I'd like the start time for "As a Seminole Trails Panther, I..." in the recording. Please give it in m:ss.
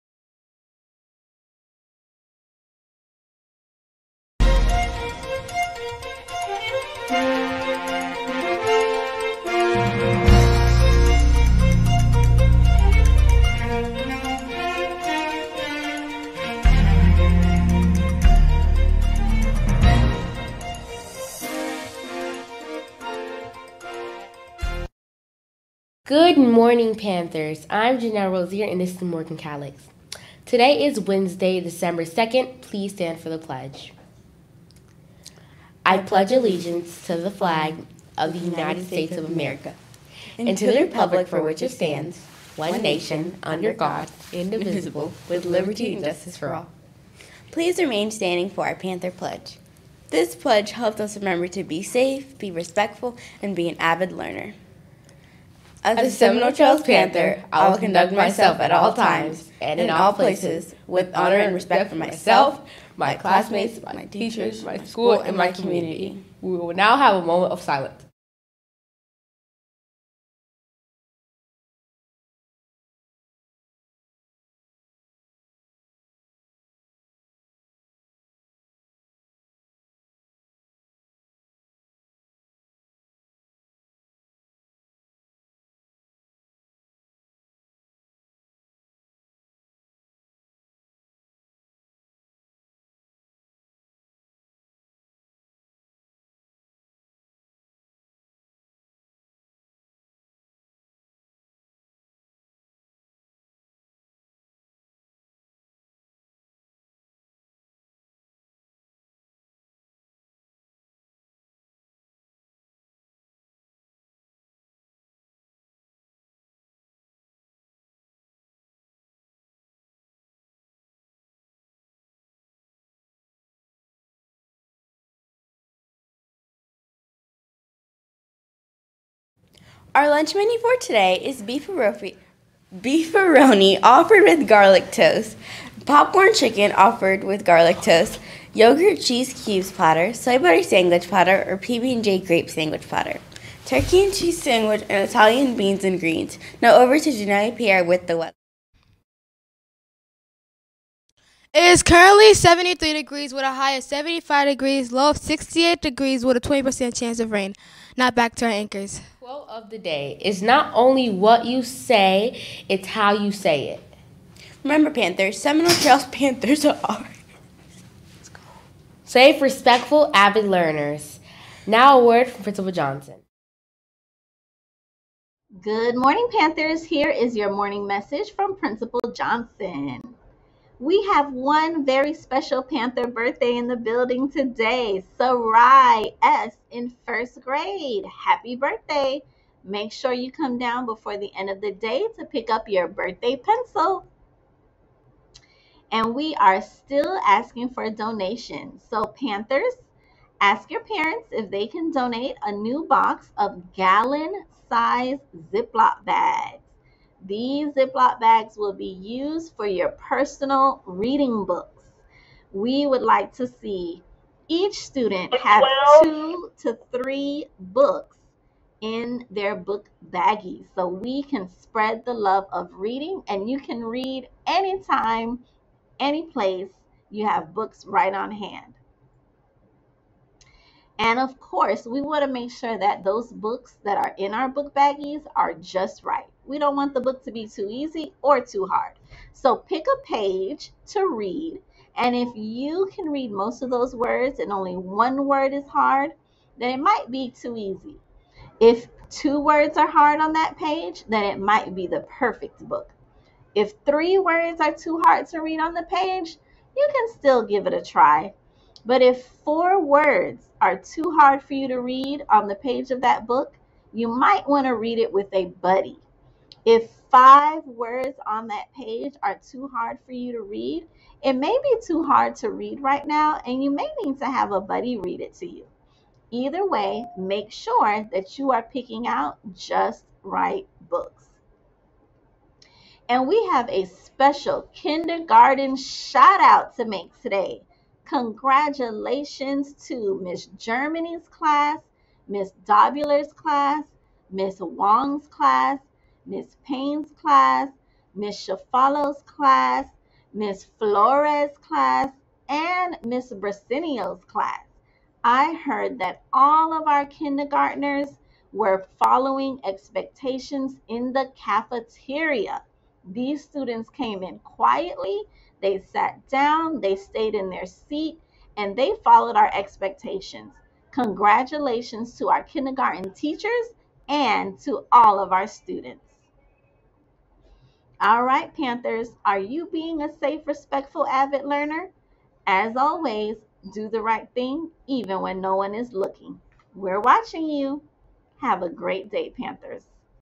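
0:55.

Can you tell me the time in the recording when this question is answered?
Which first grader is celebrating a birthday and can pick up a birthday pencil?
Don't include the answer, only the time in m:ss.
3:05.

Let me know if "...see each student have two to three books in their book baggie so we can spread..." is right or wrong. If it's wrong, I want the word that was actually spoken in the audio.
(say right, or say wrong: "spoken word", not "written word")
right.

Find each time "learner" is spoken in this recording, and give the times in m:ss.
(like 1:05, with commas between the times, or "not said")
0:54, 2:50, 5:31.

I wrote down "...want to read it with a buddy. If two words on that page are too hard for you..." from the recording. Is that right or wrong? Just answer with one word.
wrong.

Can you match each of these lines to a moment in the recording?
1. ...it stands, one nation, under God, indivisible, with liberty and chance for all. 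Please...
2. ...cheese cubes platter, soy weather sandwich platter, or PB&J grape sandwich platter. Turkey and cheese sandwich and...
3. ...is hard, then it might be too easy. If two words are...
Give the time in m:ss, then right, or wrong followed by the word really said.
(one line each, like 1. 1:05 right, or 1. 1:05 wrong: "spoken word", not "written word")
1. 0:41 wrong: "justice", not "chance"
2. 2:19 wrong: "butter", not "weather"
3. 4:05 right.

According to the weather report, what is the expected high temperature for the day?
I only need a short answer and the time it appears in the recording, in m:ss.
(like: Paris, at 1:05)
75 degrees, at 2:33.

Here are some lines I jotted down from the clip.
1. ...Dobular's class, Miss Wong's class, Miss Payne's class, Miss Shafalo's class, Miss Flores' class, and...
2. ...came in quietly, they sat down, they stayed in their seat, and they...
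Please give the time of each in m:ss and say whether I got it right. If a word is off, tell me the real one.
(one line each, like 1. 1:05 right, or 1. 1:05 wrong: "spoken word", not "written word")
1. 4:52 right
2. 5:13 right.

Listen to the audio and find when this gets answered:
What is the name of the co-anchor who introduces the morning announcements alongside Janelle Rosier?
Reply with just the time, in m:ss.
0:29.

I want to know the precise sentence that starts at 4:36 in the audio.
Either way, make sure that you are picking out just right books.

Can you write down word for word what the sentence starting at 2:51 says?
Now a word from Principal Johnson.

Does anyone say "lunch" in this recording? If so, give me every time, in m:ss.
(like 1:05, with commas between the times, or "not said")
2:10.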